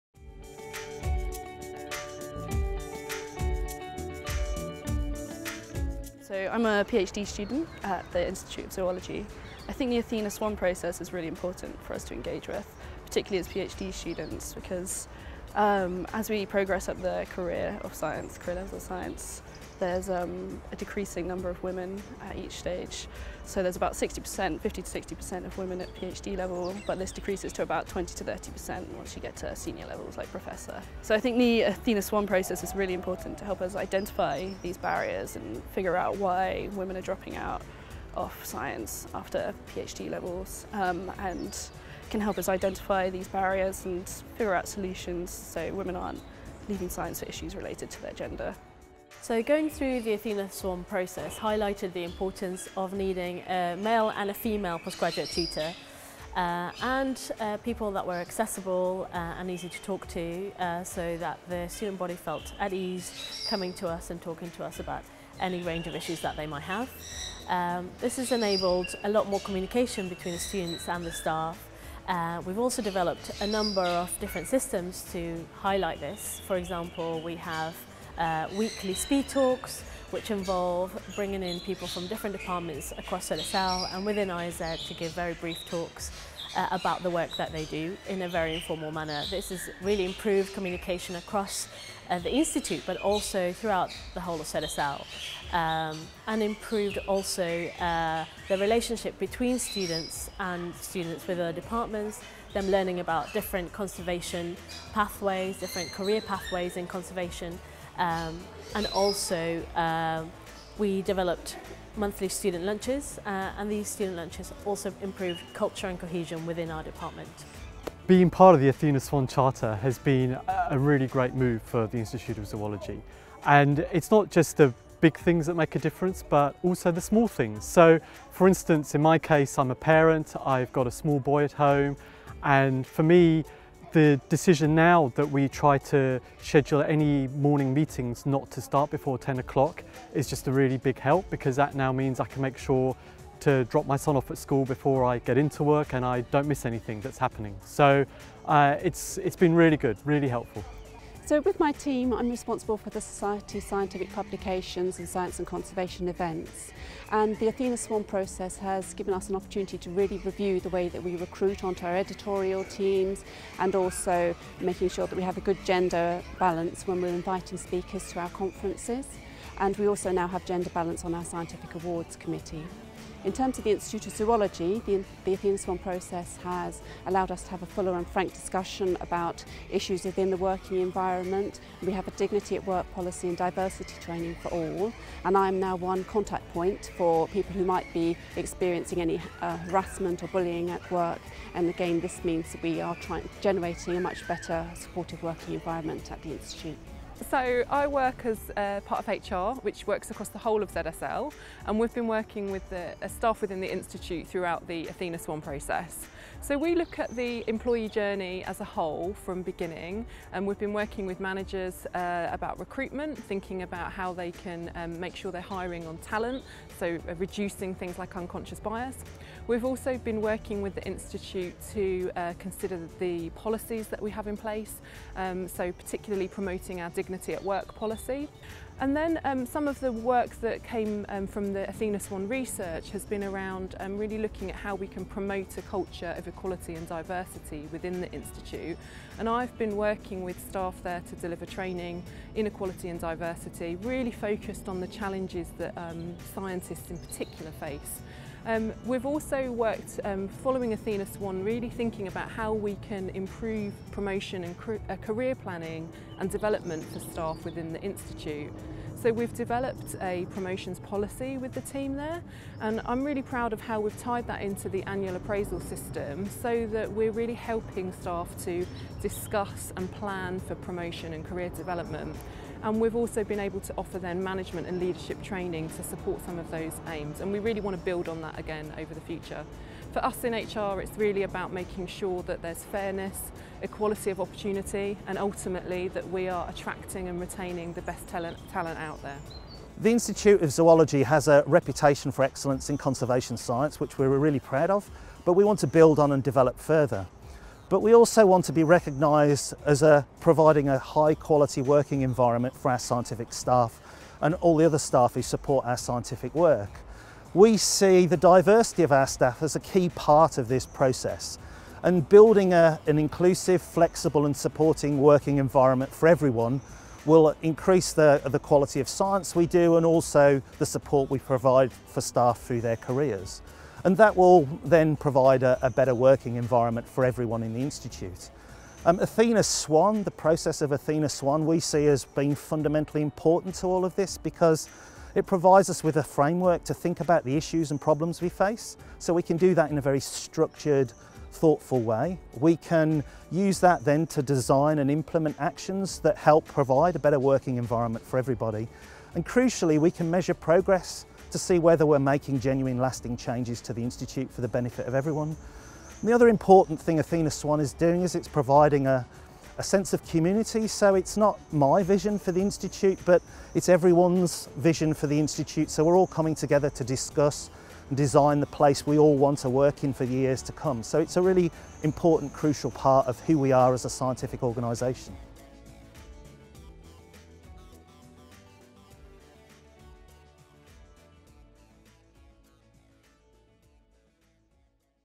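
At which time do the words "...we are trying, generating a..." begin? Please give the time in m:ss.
3:12.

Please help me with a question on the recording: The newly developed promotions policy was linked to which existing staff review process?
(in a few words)
Annual appraisal system.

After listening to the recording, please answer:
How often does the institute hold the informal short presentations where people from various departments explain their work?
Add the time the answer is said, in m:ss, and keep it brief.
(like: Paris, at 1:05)
Weekly, at 1:18.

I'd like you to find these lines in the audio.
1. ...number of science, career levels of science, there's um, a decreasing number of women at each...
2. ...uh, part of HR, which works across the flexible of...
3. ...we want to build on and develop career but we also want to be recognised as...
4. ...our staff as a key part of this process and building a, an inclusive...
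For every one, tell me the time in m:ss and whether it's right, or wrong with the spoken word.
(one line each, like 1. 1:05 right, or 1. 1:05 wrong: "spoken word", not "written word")
1. 0:17 wrong: "career", not "number"
2. 3:18 wrong: "whole", not "flexible"
3. 4:55 wrong: "further", not "career"
4. 5:08 right.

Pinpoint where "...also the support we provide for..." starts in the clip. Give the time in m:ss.
5:19.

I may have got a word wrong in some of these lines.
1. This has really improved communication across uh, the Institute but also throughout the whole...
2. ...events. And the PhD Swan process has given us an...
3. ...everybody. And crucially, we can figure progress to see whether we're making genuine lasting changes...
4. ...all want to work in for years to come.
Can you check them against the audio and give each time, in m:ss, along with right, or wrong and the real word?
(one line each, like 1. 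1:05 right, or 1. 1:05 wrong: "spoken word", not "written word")
1. 1:29 right
2. 2:36 wrong: "Athena", not "PhD"
3. 5:48 wrong: "measure", not "figure"
4. 6:08 right.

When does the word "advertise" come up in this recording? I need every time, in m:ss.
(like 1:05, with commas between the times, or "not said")
not said.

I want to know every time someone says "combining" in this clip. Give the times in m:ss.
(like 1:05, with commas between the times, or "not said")
not said.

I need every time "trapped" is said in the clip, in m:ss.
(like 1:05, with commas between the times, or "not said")
not said.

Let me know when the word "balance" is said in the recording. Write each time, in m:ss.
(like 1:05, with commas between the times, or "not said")
2:46, 2:50.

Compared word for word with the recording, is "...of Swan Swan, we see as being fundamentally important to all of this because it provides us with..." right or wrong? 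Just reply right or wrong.
wrong.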